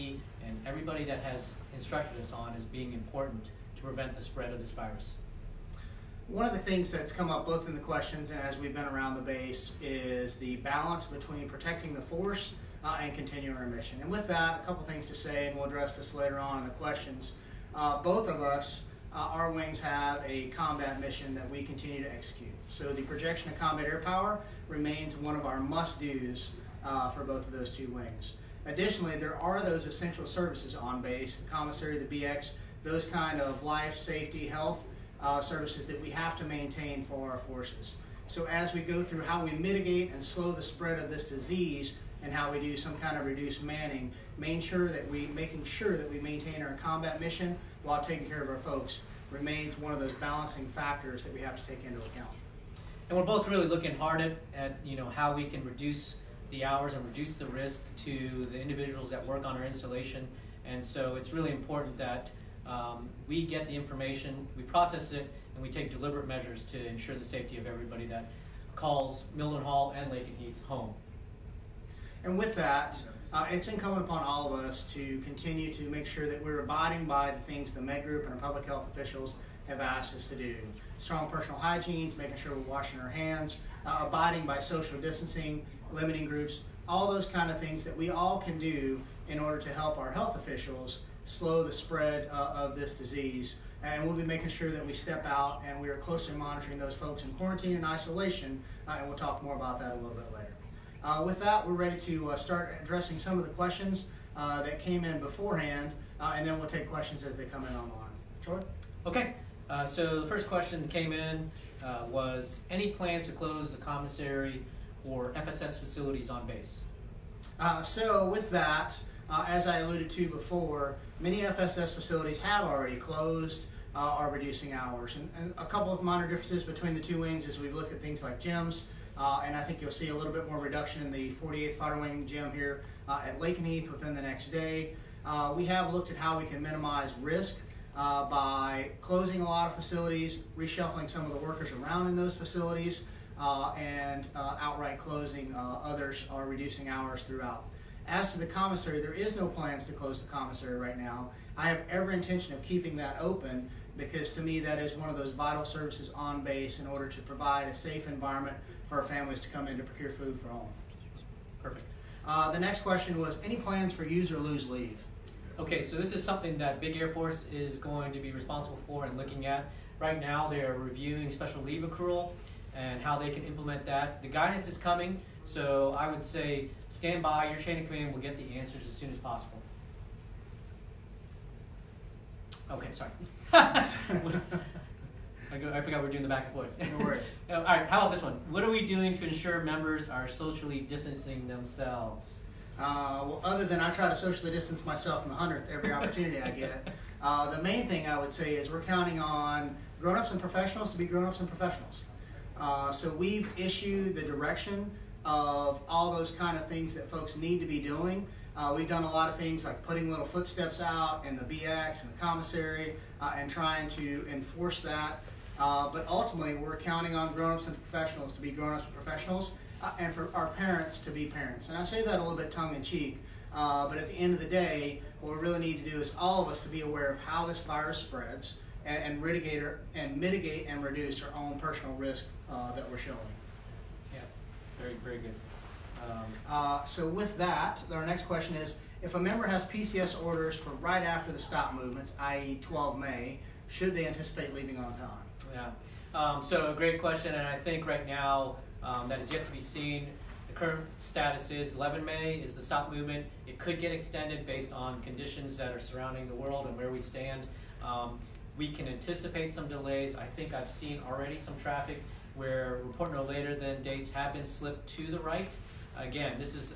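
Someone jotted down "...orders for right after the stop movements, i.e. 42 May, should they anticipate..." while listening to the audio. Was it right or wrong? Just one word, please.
wrong.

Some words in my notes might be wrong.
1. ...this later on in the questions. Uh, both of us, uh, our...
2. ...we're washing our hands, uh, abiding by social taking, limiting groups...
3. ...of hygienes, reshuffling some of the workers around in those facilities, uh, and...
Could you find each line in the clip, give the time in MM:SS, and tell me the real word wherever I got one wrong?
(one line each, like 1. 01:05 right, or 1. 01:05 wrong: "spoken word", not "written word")
1. 00:15 right
2. 01:22 wrong: "distancing", not "taking"
3. 02:19 wrong: "facilities", not "hygienes".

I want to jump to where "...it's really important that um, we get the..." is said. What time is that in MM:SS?
01:01.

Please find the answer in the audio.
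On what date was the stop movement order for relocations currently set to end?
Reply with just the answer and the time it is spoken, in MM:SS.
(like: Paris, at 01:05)
11 May, at 04:11.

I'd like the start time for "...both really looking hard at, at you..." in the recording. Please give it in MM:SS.
00:53.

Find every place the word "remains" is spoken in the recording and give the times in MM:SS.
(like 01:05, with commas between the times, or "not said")
00:24, 00:49.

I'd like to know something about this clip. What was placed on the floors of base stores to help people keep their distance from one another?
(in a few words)
Little footsteps.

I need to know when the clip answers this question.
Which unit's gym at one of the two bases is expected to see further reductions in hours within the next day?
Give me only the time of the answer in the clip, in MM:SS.
02:11.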